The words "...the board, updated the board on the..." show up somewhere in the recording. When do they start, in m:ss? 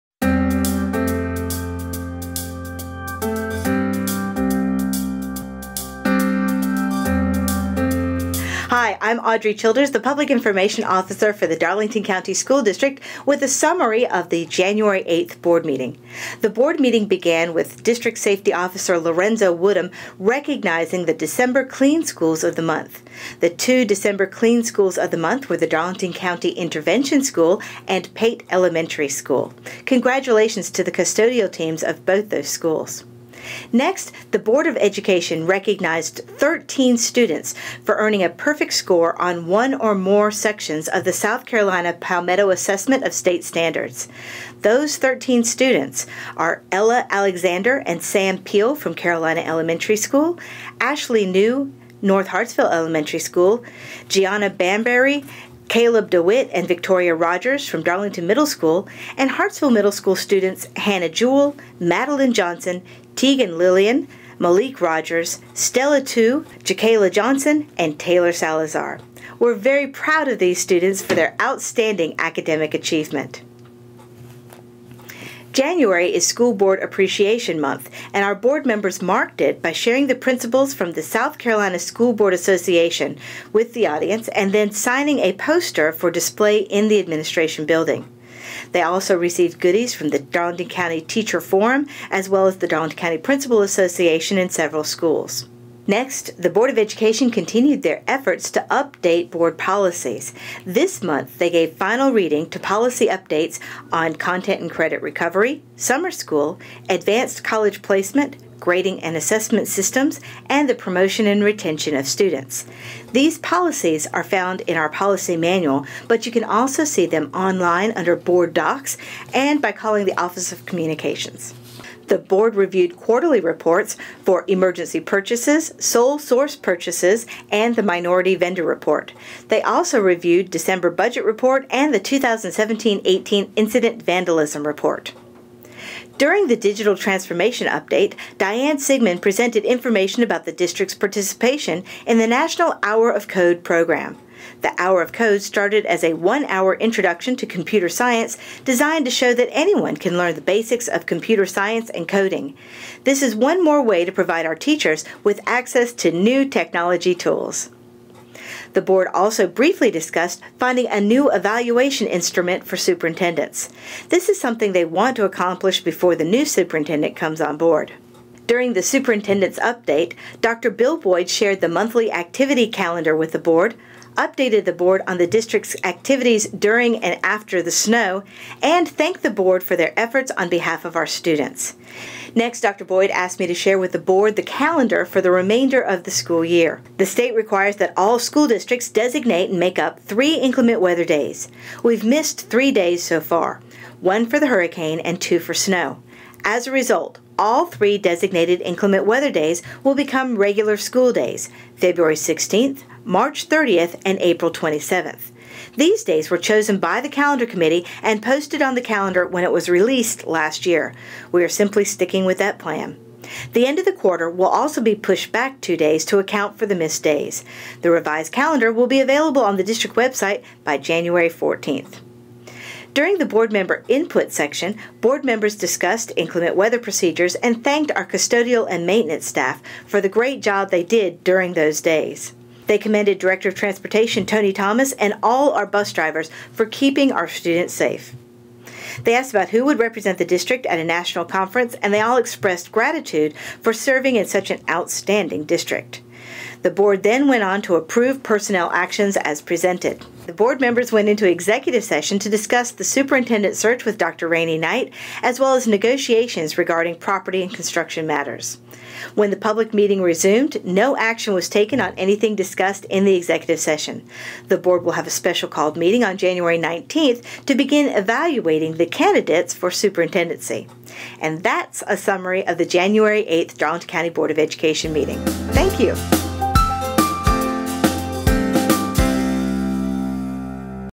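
2:53.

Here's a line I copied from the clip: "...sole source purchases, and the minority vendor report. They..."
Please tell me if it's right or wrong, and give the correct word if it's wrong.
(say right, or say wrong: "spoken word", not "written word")
right.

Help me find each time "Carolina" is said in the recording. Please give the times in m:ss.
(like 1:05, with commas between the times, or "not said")
0:41, 0:48, 1:21.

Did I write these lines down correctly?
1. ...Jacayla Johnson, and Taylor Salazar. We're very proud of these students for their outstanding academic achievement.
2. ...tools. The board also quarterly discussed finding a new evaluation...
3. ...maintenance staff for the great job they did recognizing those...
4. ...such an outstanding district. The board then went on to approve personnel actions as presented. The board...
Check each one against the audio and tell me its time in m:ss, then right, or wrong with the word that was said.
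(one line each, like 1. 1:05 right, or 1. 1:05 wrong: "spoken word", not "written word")
1. 1:06 right
2. 2:37 wrong: "briefly", not "quarterly"
3. 3:48 wrong: "during", not "recognizing"
4. 4:04 right.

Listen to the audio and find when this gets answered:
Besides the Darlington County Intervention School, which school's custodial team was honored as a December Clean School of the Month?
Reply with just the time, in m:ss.
0:28.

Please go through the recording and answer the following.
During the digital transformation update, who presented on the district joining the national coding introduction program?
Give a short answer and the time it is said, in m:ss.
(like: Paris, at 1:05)
Diane Sigmund, at 2:18.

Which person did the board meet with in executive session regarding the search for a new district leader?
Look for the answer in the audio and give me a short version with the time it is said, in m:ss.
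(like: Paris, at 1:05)
Dr. Rainey Knight, at 4:13.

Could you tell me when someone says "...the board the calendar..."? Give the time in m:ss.
3:03.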